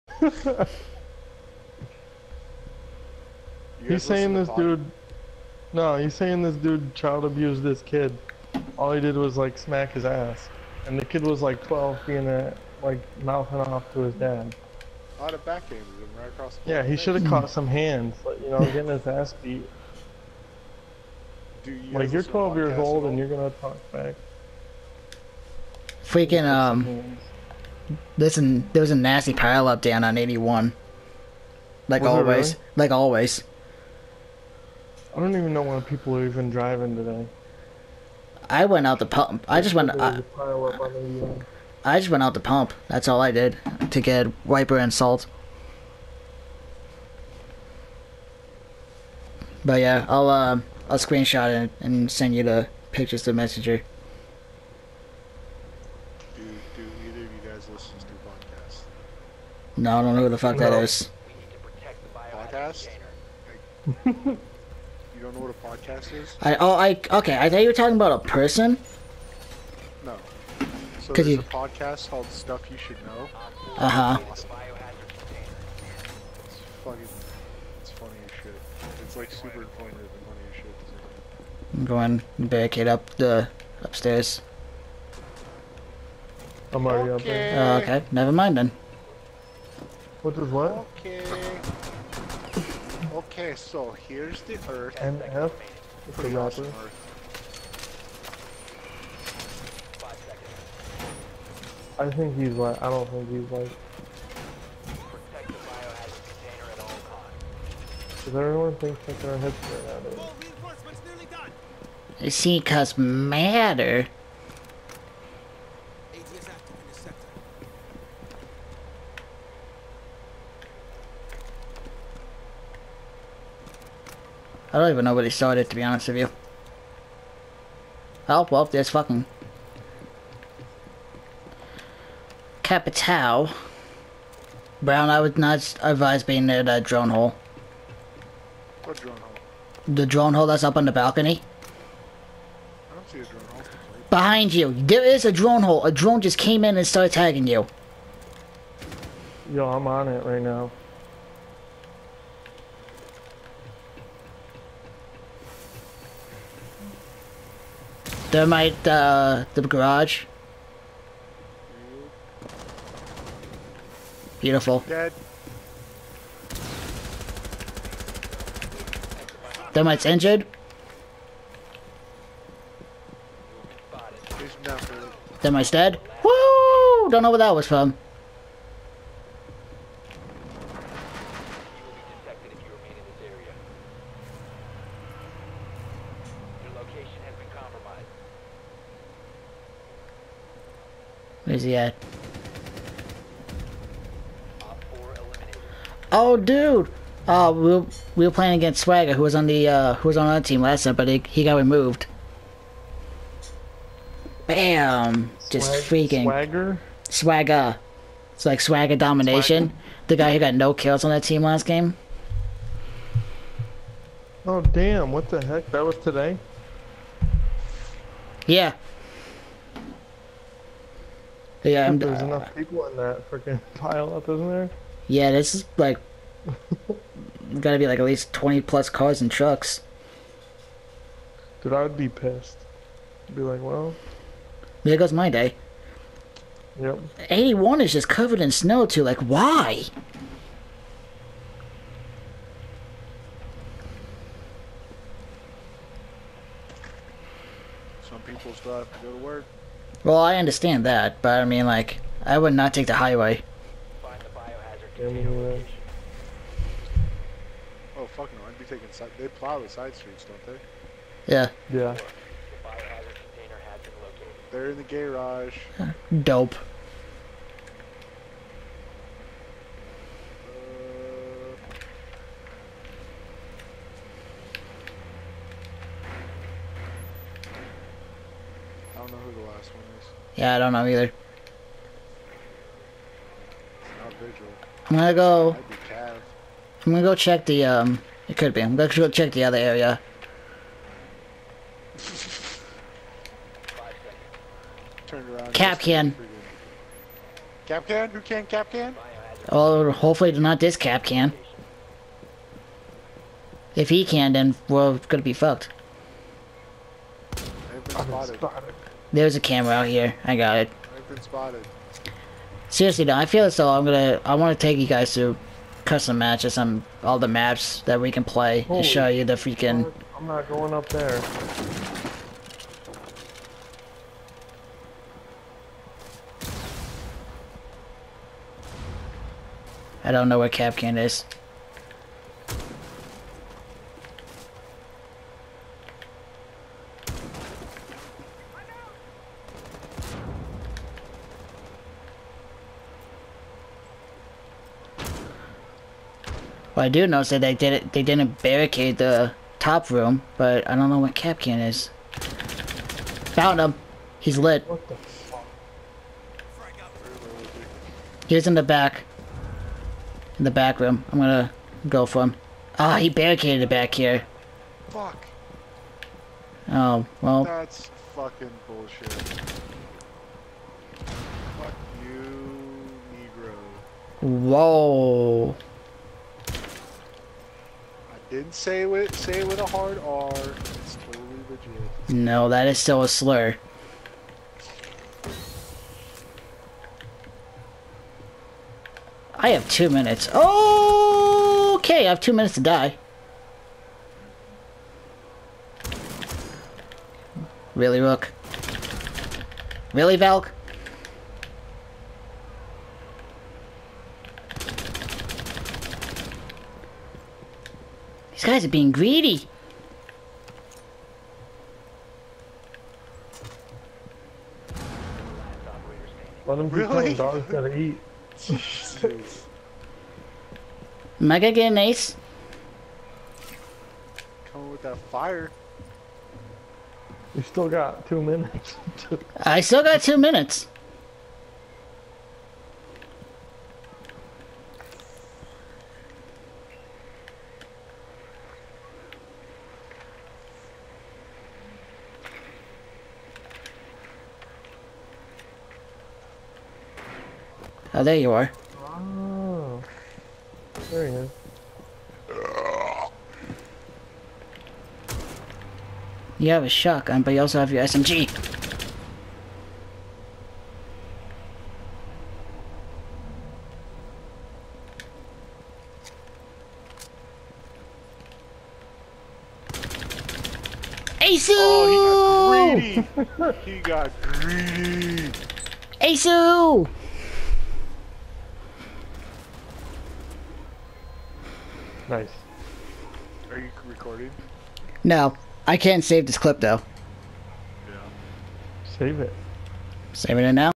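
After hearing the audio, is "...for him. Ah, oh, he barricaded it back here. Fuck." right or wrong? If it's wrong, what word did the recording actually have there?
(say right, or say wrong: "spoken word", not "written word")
right.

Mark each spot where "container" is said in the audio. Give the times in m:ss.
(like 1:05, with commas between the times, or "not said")
4:14, 4:23.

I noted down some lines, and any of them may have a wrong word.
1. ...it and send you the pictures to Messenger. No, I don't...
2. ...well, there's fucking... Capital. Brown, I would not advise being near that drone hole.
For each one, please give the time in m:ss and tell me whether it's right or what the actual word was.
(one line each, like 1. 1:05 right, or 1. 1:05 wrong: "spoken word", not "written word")
1. 0:51 right
2. 2:08 right.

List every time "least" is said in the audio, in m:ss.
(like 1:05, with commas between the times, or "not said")
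3:48.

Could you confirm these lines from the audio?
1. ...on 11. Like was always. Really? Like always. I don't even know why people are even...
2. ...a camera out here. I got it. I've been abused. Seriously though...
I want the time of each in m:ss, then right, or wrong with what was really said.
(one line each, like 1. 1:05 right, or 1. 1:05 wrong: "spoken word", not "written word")
1. 0:30 wrong: "81", not "11"
2. 5:09 wrong: "spotted", not "abused".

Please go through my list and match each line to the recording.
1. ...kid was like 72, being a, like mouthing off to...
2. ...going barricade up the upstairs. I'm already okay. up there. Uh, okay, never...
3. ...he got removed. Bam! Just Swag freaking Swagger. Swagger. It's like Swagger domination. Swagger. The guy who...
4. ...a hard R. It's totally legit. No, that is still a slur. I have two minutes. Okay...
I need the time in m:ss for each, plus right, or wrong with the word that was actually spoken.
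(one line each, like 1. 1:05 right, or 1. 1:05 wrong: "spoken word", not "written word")
1. 0:11 wrong: "12", not "72"
2. 1:21 right
3. 3:21 right
4. 6:19 right.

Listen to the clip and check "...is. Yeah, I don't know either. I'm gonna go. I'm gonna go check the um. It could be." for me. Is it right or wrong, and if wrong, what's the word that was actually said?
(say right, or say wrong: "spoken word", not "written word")
right.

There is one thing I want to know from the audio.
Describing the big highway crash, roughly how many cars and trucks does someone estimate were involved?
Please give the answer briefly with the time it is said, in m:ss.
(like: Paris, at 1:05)
20+, at 3:48.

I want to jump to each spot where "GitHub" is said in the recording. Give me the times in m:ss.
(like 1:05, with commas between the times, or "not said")
not said.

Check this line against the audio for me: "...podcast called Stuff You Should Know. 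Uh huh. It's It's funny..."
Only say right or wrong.
right.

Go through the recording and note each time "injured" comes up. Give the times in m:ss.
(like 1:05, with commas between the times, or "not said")
2:50.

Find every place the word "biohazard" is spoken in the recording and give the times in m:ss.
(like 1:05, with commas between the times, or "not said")
4:14, 4:22.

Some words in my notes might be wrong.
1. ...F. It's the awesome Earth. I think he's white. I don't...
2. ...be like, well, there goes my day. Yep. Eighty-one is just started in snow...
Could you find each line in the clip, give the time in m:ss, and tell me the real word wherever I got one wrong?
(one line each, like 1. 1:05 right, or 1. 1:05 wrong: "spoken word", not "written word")
1. 1:35 right
2. 3:53 wrong: "covered", not "started".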